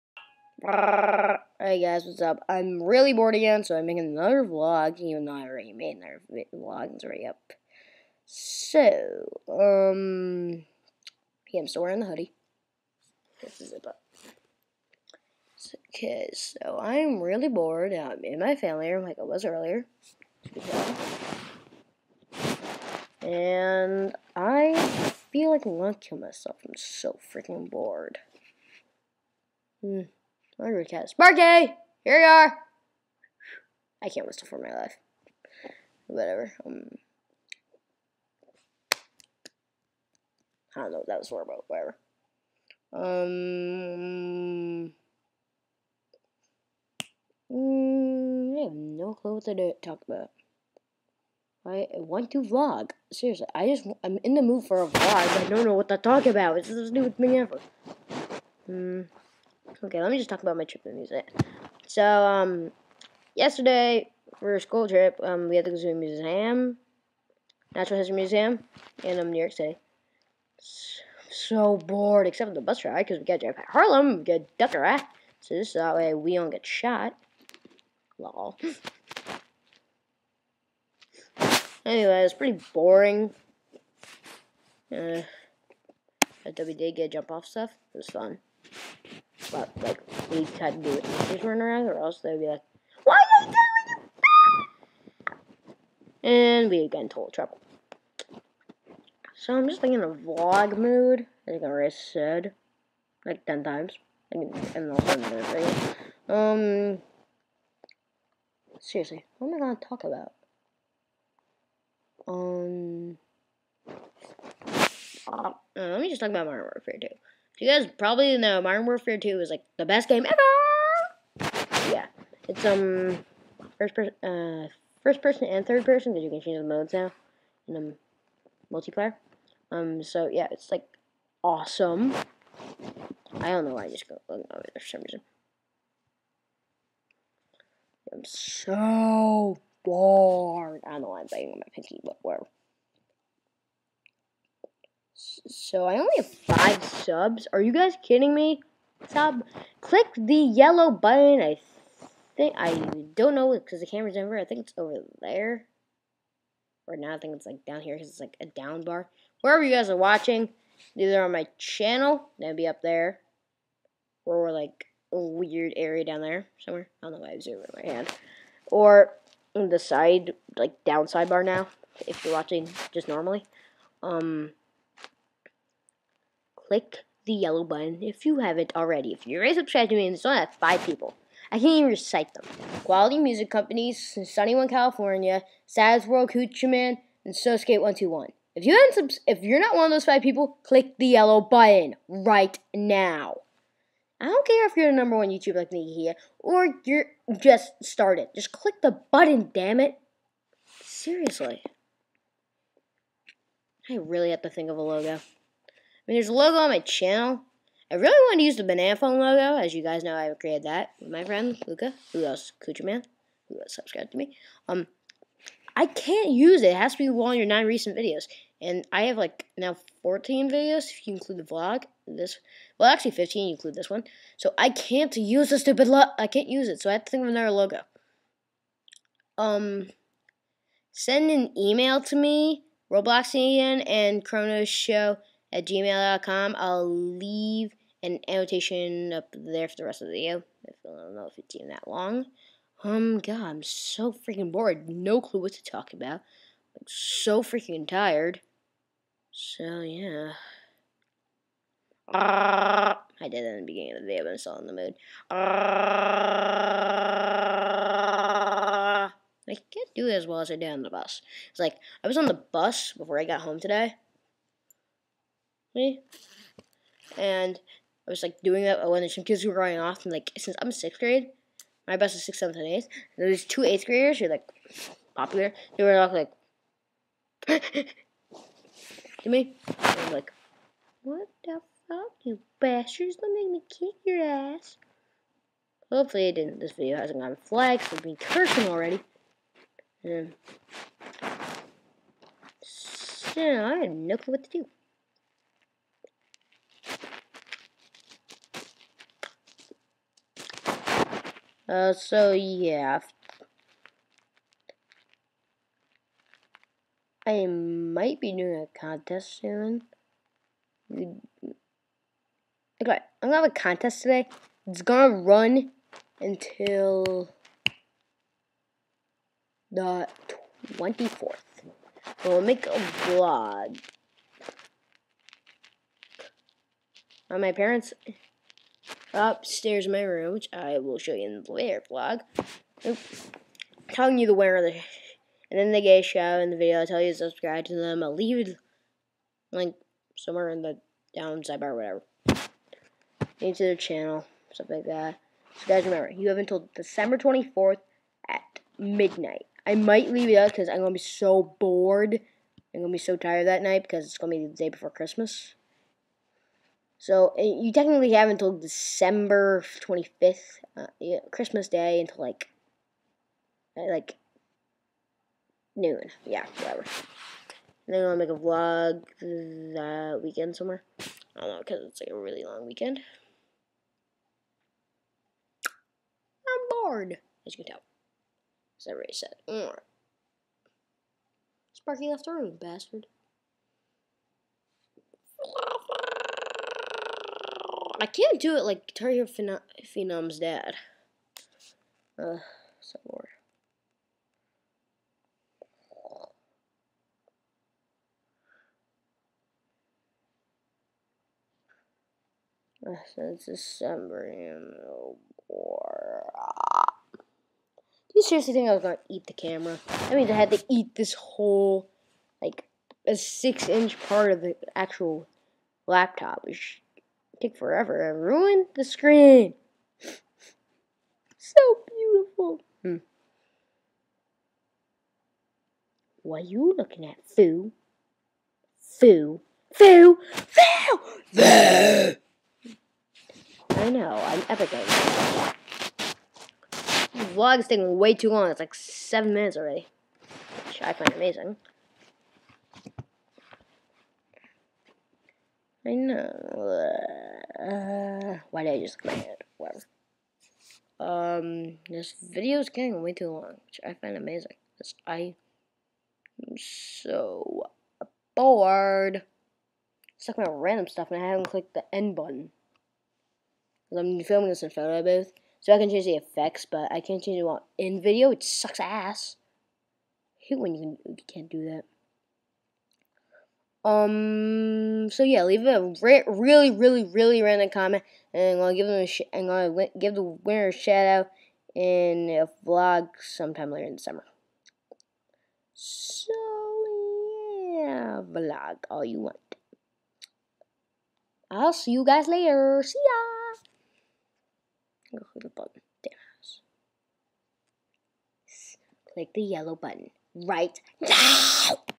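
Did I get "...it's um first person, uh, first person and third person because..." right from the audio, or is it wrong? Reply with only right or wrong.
right.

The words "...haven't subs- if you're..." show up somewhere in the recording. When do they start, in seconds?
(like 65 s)
188 s.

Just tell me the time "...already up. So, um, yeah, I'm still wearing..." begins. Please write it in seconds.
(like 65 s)
7 s.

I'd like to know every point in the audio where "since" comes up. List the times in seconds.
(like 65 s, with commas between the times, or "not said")
270 s, 403 s.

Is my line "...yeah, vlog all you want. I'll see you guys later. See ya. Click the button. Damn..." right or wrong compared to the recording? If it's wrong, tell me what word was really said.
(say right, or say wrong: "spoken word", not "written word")
right.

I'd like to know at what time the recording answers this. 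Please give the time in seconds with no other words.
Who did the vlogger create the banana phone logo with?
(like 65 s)
211 s.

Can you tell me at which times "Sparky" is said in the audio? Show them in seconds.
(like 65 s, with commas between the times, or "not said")
31 s, 381 s.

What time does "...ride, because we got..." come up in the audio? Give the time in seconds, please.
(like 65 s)
72 s.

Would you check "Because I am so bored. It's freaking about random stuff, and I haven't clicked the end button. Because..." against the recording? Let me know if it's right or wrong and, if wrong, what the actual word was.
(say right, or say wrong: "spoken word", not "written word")
wrong: "talking", not "freaking".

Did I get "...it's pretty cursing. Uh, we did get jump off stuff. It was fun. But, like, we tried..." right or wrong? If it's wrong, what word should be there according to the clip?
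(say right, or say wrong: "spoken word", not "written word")
wrong: "boring", not "cursing".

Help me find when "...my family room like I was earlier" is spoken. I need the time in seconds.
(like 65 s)
18 s.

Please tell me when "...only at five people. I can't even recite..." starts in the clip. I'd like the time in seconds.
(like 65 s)
180 s.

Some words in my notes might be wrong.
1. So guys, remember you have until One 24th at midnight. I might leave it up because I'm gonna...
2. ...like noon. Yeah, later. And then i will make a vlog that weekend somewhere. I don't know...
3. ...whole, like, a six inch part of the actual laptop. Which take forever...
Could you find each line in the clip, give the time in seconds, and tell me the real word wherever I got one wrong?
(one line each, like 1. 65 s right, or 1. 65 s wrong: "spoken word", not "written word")
1. 345 s wrong: "December", not "One"
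2. 363 s wrong: "whatever", not "later"
3. 411 s right.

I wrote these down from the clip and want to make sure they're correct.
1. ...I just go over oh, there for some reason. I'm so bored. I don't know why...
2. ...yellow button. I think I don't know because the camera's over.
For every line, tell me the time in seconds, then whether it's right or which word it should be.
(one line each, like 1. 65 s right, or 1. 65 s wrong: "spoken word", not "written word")
1. 133 s right
2. 150 s right.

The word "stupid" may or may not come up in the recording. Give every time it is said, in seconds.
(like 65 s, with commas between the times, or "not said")
56 s, 225 s.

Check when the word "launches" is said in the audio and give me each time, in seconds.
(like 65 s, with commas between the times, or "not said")
not said.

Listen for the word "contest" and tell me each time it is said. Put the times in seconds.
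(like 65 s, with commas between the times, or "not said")
308 s, 313 s.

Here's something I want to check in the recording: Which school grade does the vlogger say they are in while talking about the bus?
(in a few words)
sixth grade.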